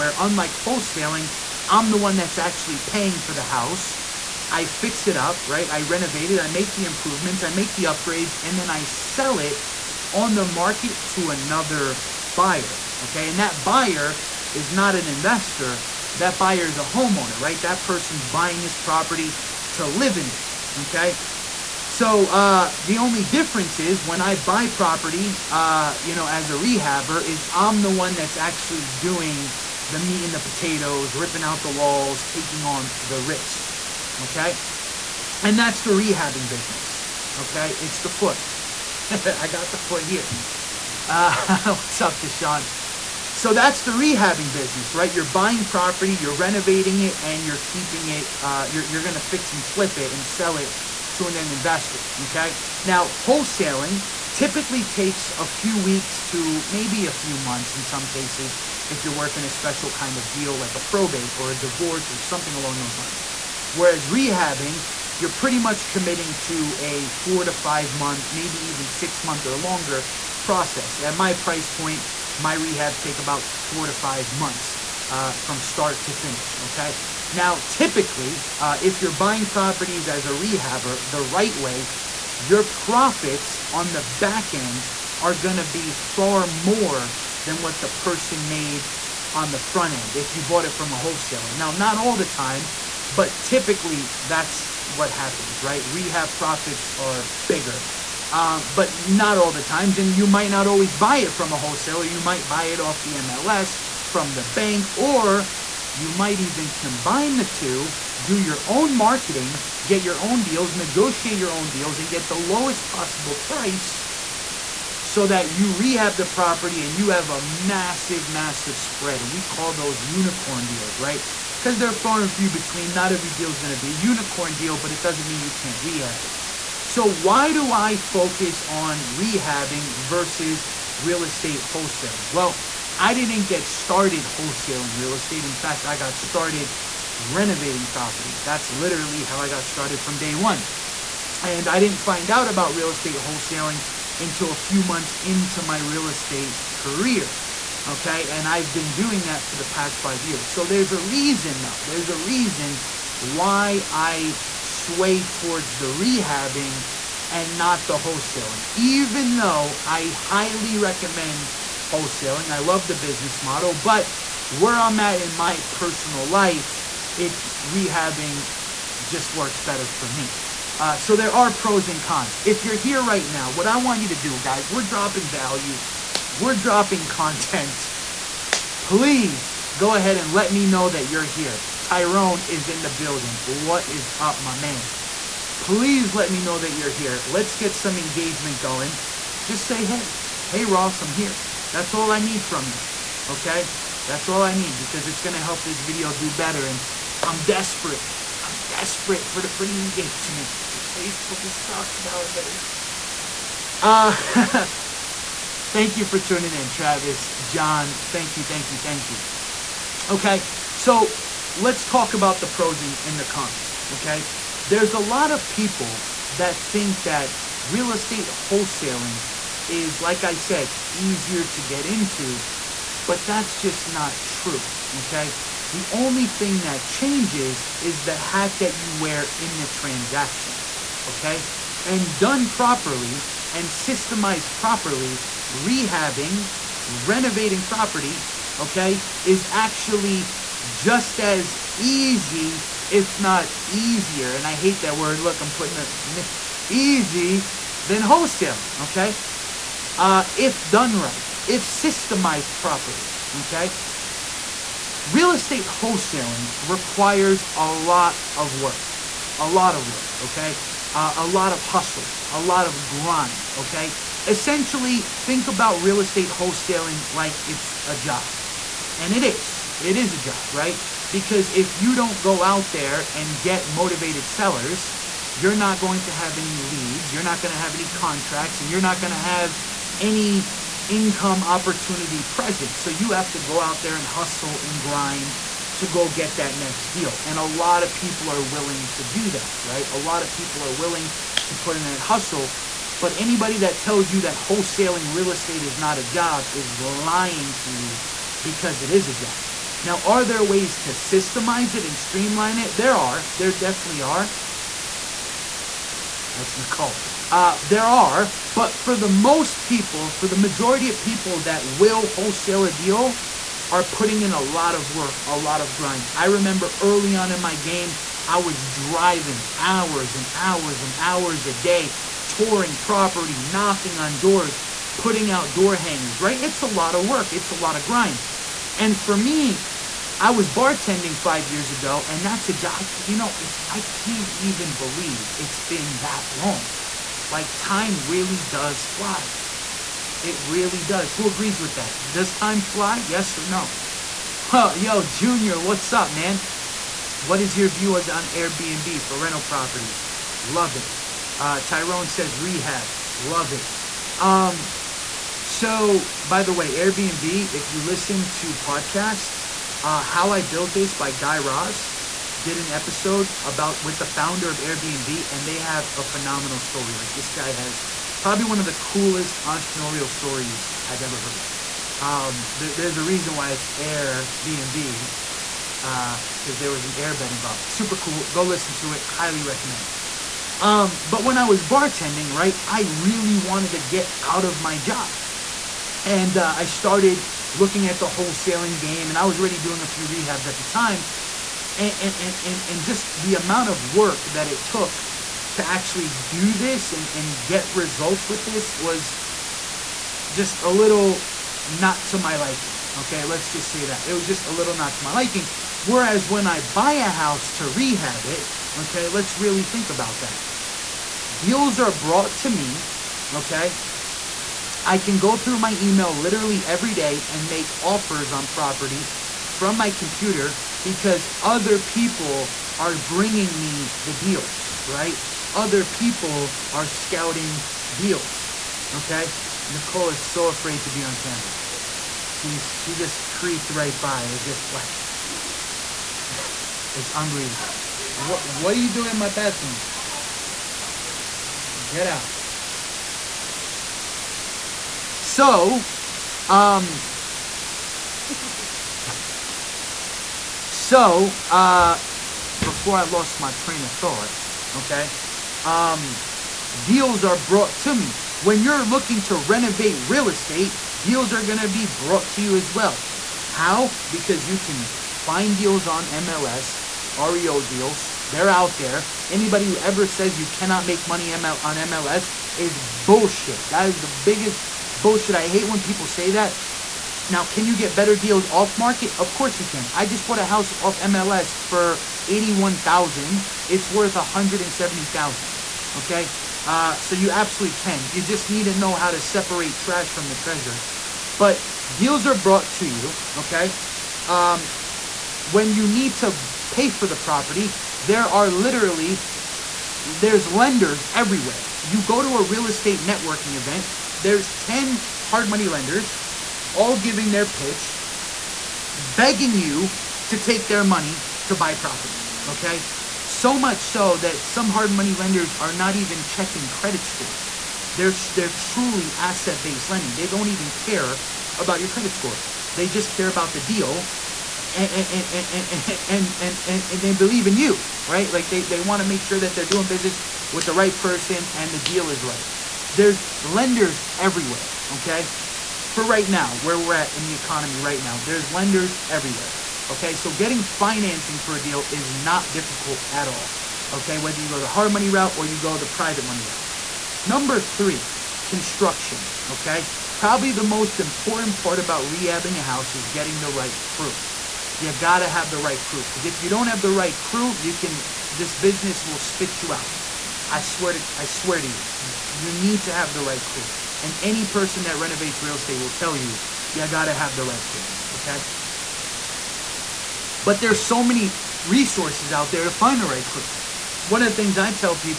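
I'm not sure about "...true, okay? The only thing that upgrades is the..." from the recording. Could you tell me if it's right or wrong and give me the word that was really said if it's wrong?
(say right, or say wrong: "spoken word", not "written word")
wrong: "changes", not "upgrades".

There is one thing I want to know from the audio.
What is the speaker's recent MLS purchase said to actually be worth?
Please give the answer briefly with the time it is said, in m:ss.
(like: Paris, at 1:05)
170,000, at 8:04.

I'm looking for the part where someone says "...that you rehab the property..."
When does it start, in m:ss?
1:55.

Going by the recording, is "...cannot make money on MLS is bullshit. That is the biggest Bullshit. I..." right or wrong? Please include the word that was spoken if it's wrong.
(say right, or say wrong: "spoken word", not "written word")
right.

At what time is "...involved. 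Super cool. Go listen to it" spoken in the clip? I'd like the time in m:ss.
6:17.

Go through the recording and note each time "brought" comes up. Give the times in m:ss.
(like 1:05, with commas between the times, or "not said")
6:51, 7:37, 7:41, 8:12.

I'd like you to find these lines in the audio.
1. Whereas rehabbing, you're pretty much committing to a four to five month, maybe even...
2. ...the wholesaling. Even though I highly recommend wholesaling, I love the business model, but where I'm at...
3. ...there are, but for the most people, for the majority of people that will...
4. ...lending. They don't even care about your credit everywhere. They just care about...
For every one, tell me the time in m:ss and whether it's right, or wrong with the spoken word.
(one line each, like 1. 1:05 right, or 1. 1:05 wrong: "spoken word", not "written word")
1. 1:03 right
2. 2:37 right
3. 5:07 right
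4. 8:39 wrong: "score", not "everywhere".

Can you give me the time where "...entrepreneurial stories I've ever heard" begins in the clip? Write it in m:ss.
6:09.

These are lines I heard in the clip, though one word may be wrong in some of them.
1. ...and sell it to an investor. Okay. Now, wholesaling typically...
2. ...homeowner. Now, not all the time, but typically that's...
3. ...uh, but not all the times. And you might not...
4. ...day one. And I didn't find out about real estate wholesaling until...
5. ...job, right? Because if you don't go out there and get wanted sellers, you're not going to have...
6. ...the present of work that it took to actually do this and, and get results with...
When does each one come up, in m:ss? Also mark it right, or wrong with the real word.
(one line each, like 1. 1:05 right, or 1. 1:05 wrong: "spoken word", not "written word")
1. 0:50 right
2. 1:30 wrong: "wholesaler", not "homeowner"
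3. 1:38 right
4. 2:20 right
5. 4:30 wrong: "motivated", not "wanted"
6. 6:33 wrong: "amount", not "present".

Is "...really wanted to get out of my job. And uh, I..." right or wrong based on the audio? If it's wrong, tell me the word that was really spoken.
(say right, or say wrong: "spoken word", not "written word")
right.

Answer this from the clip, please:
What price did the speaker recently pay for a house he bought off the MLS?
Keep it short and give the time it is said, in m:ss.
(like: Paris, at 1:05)
81,000, at 8:02.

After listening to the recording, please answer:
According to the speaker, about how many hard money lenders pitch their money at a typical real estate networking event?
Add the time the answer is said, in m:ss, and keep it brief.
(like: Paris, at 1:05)
10, at 8:24.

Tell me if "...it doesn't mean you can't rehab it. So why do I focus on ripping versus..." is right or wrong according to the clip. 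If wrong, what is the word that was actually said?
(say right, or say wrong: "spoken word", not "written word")
wrong: "rehabbing", not "ripping".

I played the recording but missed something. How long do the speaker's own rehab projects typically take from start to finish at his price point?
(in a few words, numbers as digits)
4 to 5 months.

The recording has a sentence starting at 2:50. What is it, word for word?
Uh, so there are pros and cons.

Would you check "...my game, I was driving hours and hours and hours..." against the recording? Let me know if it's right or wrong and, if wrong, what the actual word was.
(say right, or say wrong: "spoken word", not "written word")
right.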